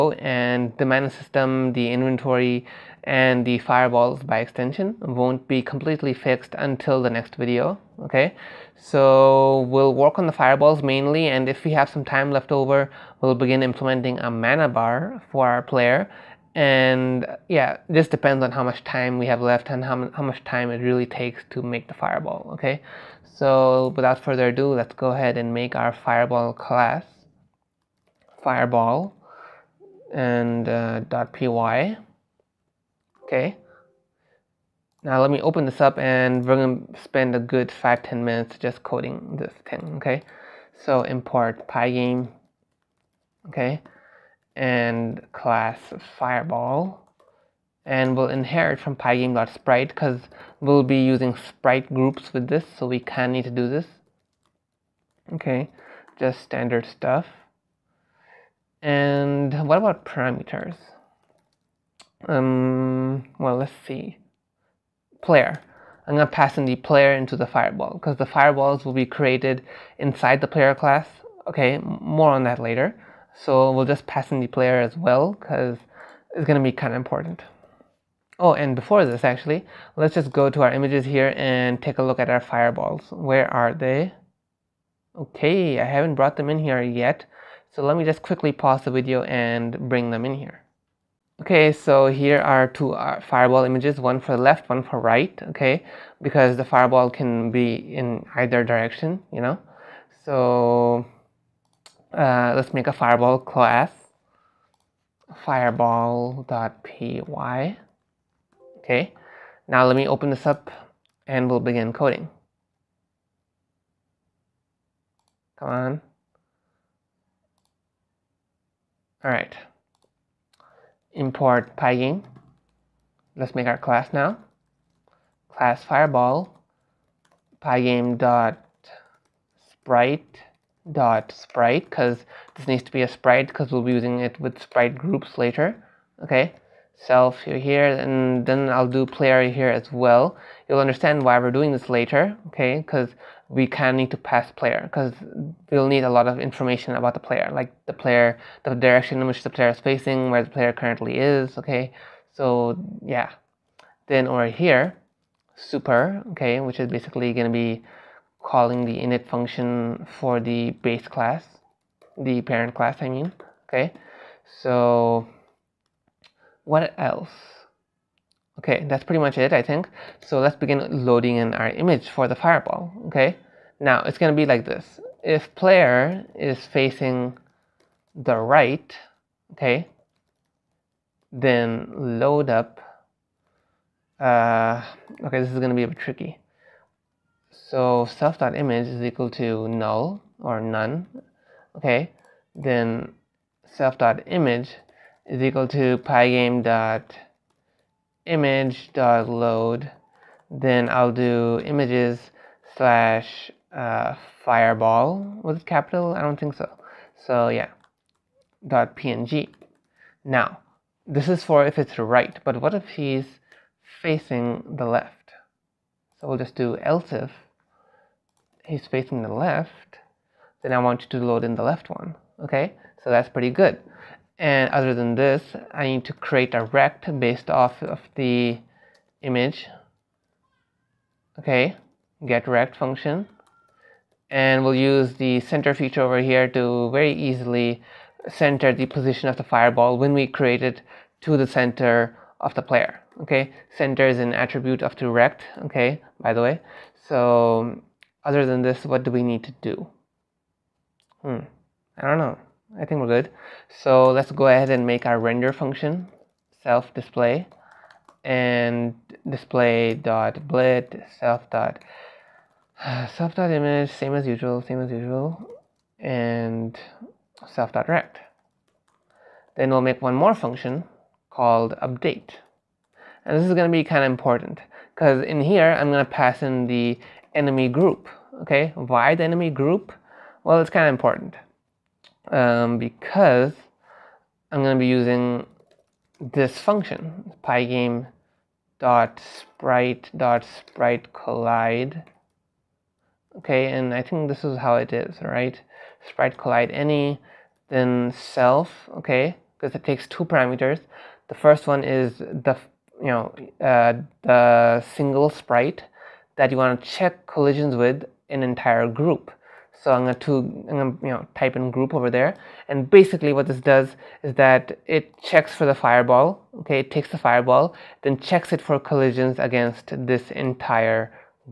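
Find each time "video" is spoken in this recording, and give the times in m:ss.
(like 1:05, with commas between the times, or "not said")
0:07, 1:28.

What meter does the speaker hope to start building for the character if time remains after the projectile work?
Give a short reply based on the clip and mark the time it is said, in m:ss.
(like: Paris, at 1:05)
Mana bar, at 0:14.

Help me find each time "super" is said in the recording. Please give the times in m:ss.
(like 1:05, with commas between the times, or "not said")
2:35.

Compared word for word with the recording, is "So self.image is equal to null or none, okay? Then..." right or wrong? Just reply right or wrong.
right.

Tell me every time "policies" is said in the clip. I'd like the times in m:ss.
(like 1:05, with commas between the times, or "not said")
not said.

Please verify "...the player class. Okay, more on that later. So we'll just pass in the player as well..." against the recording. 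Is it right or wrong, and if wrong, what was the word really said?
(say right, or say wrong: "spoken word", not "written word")
right.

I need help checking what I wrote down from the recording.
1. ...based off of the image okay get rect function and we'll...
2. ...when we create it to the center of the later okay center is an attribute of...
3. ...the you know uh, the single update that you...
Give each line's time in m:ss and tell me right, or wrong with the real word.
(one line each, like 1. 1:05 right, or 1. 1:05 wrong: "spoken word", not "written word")
1. 3:47 right
2. 3:59 wrong: "player", not "later"
3. 5:02 wrong: "sprite", not "update".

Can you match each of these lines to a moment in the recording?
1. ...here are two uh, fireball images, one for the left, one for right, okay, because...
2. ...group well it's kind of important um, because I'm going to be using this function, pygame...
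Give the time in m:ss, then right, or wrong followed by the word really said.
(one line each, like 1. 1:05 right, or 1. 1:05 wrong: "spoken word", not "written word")
1. 1:32 right
2. 4:39 right.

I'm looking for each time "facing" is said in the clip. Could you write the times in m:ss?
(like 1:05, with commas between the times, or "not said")
2:29, 2:56, 3:34, 3:38.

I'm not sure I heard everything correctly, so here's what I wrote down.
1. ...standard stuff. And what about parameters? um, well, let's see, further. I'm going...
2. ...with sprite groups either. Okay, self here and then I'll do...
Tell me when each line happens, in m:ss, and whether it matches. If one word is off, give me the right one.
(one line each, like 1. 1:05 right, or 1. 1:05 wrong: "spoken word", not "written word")
1. 0:56 wrong: "player", not "further"
2. 2:14 wrong: "later", not "either".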